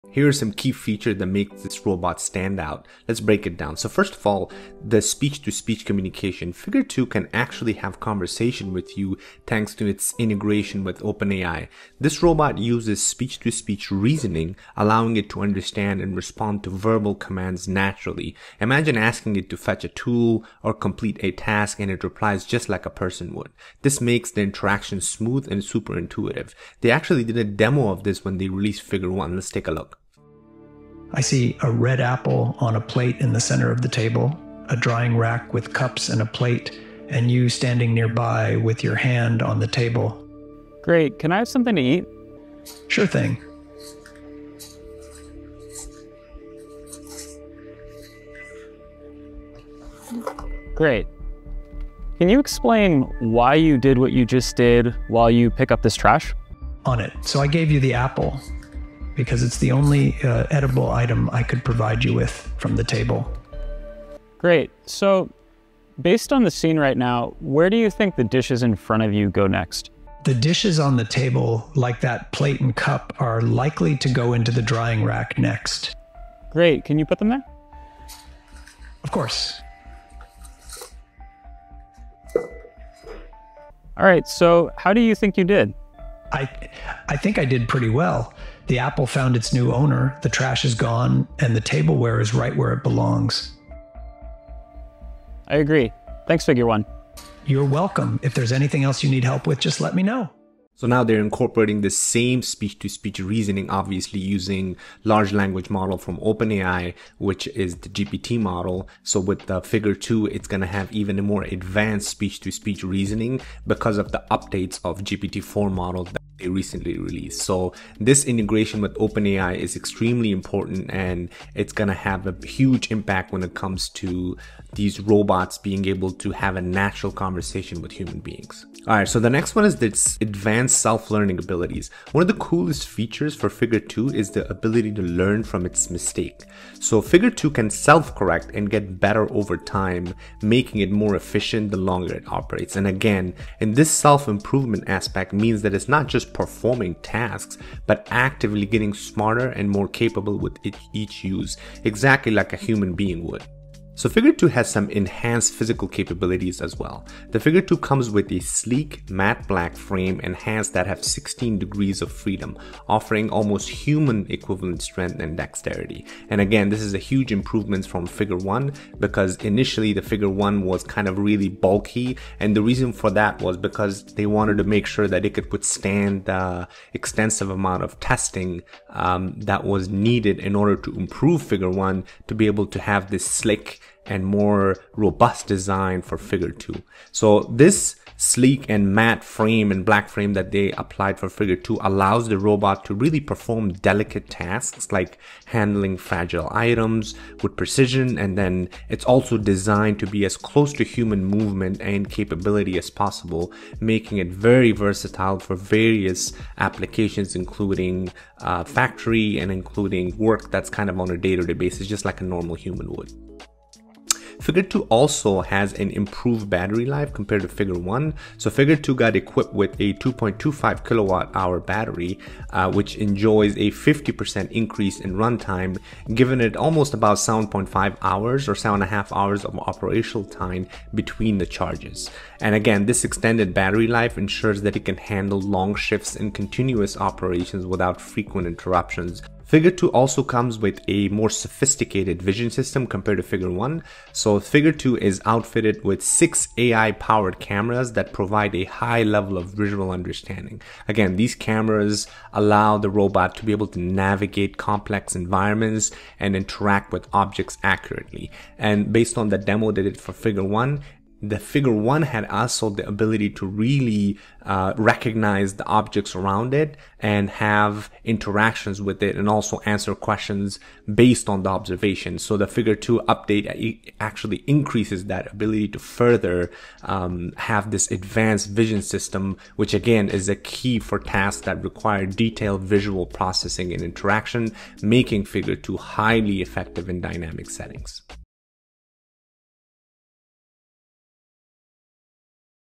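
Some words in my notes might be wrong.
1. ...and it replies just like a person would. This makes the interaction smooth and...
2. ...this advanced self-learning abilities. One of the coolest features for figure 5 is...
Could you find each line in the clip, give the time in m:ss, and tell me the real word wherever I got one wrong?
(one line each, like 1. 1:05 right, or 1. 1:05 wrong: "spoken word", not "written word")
1. 0:21 right
2. 2:09 wrong: "2", not "5".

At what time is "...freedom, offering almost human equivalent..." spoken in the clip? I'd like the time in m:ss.
2:42.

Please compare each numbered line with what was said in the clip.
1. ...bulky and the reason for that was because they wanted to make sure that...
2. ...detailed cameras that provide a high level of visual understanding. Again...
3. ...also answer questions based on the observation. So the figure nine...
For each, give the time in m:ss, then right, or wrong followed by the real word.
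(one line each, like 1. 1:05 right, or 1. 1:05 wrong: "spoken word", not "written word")
1. 2:51 right
2. 4:06 wrong: "powered", not "detailed"
3. 4:29 wrong: "two", not "nine".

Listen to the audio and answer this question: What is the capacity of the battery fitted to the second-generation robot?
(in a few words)
2.25 kilowatt hours.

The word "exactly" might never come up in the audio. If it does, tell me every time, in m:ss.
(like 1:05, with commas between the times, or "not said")
2:31.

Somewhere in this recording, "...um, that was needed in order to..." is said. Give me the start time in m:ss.
2:58.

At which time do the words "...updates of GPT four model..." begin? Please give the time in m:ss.
1:54.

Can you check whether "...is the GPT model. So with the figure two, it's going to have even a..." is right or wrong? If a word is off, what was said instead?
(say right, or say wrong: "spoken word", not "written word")
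right.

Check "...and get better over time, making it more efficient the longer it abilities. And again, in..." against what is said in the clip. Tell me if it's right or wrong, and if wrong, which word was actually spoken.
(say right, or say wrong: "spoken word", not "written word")
wrong: "operates", not "abilities".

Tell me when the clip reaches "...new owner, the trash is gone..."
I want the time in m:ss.
1:29.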